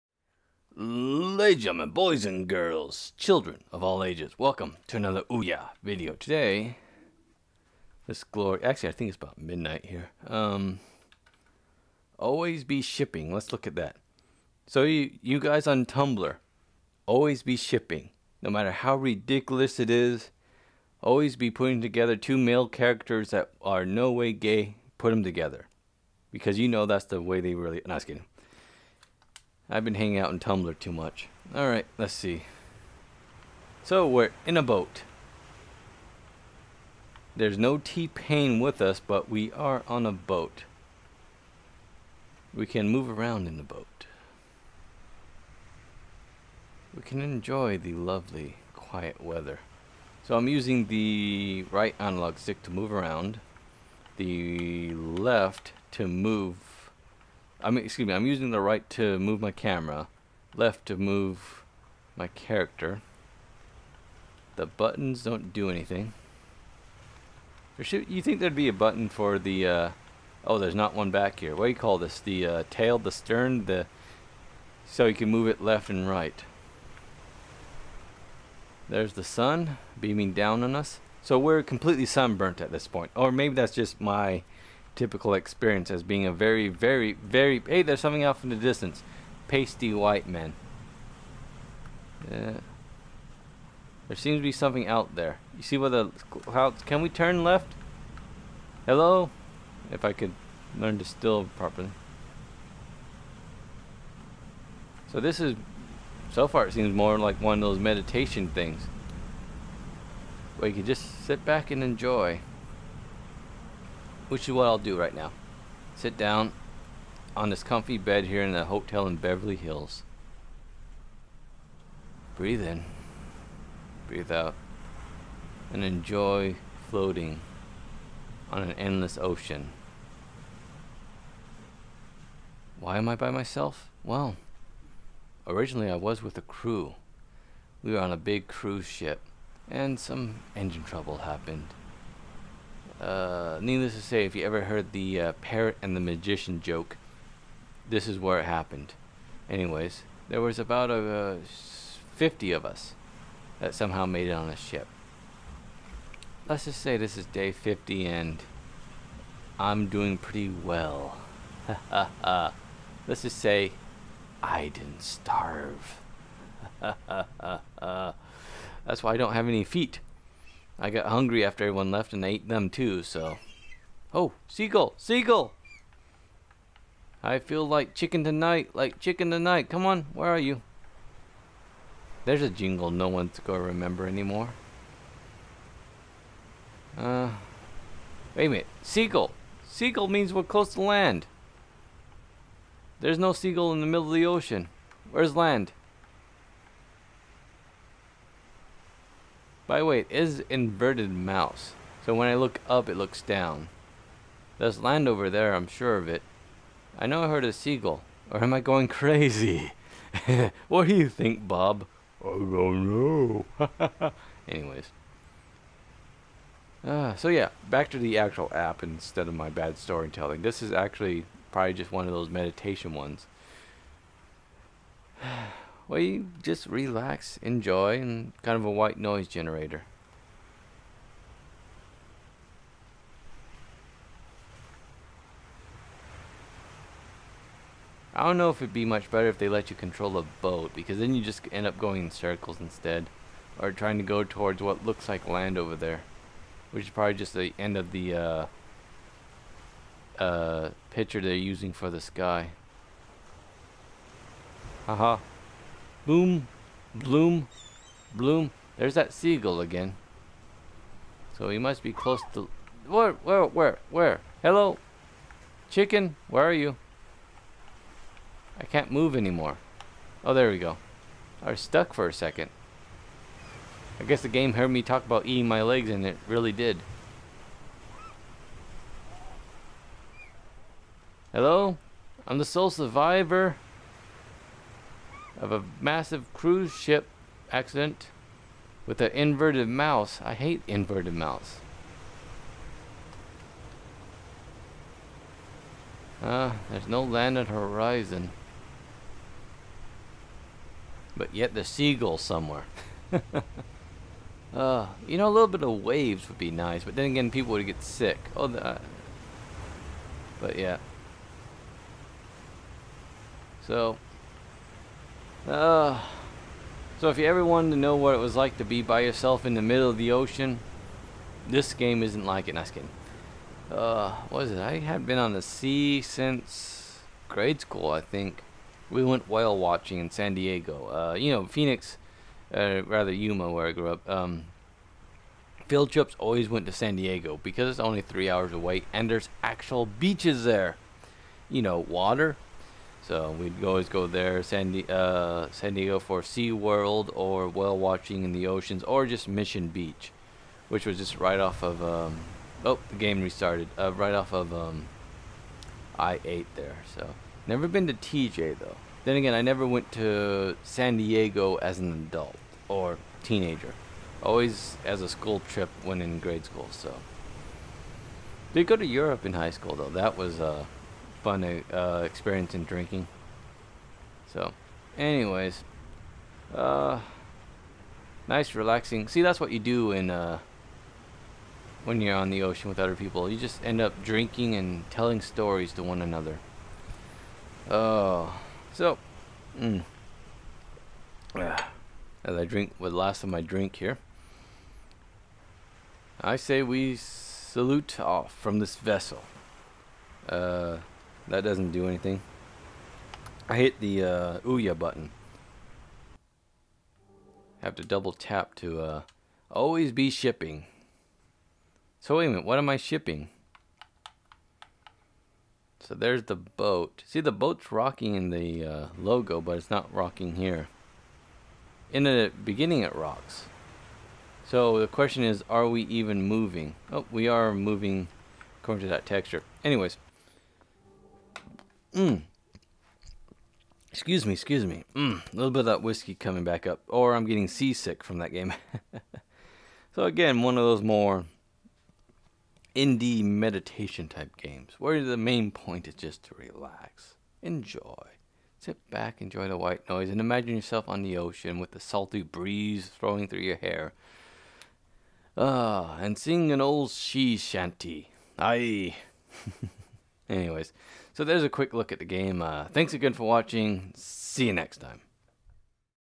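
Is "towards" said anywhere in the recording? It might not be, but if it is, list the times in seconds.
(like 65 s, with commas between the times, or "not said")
244 s.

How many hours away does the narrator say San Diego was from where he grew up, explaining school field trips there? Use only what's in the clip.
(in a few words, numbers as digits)
3.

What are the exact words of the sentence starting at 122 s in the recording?
Breathe in, breathe out, and enjoy floating on an endless ocean.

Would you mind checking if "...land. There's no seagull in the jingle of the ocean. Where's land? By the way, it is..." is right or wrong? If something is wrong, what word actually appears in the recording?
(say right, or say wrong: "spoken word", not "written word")
wrong: "middle", not "jingle".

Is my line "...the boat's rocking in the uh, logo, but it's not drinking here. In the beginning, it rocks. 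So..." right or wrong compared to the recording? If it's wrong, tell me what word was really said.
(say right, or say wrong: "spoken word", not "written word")
wrong: "rocking", not "drinking".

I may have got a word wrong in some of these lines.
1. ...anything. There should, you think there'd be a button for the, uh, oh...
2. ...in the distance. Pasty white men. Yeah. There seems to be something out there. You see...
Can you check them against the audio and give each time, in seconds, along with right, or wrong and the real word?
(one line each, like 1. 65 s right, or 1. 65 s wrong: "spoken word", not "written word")
1. 65 s right
2. 88 s right.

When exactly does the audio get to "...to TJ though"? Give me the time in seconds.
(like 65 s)
357 s.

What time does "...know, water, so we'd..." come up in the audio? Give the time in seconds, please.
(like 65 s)
341 s.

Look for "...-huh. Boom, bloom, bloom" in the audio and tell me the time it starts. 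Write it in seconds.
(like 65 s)
255 s.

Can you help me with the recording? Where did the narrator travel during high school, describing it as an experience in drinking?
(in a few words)
Europe.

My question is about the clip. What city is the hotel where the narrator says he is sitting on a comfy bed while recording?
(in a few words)
Beverly Hills.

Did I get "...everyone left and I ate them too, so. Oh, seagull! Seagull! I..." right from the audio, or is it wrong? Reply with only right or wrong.
right.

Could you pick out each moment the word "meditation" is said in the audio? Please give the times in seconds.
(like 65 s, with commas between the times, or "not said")
107 s, 222 s, 443 s.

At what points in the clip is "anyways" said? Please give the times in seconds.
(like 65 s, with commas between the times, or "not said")
149 s, 214 s, 374 s, 429 s, 460 s.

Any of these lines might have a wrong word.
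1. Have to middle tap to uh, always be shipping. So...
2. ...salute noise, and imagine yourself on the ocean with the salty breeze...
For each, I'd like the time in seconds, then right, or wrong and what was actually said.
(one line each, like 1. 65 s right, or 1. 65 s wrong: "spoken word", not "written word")
1. 407 s wrong: "double", not "middle"
2. 449 s wrong: "white", not "salute".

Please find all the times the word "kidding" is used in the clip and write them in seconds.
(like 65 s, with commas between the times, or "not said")
28 s, 322 s.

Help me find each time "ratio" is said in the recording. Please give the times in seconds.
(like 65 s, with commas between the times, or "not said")
not said.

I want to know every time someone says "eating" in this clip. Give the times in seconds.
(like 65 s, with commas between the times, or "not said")
275 s.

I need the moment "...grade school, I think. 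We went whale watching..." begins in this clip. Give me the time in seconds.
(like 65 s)
327 s.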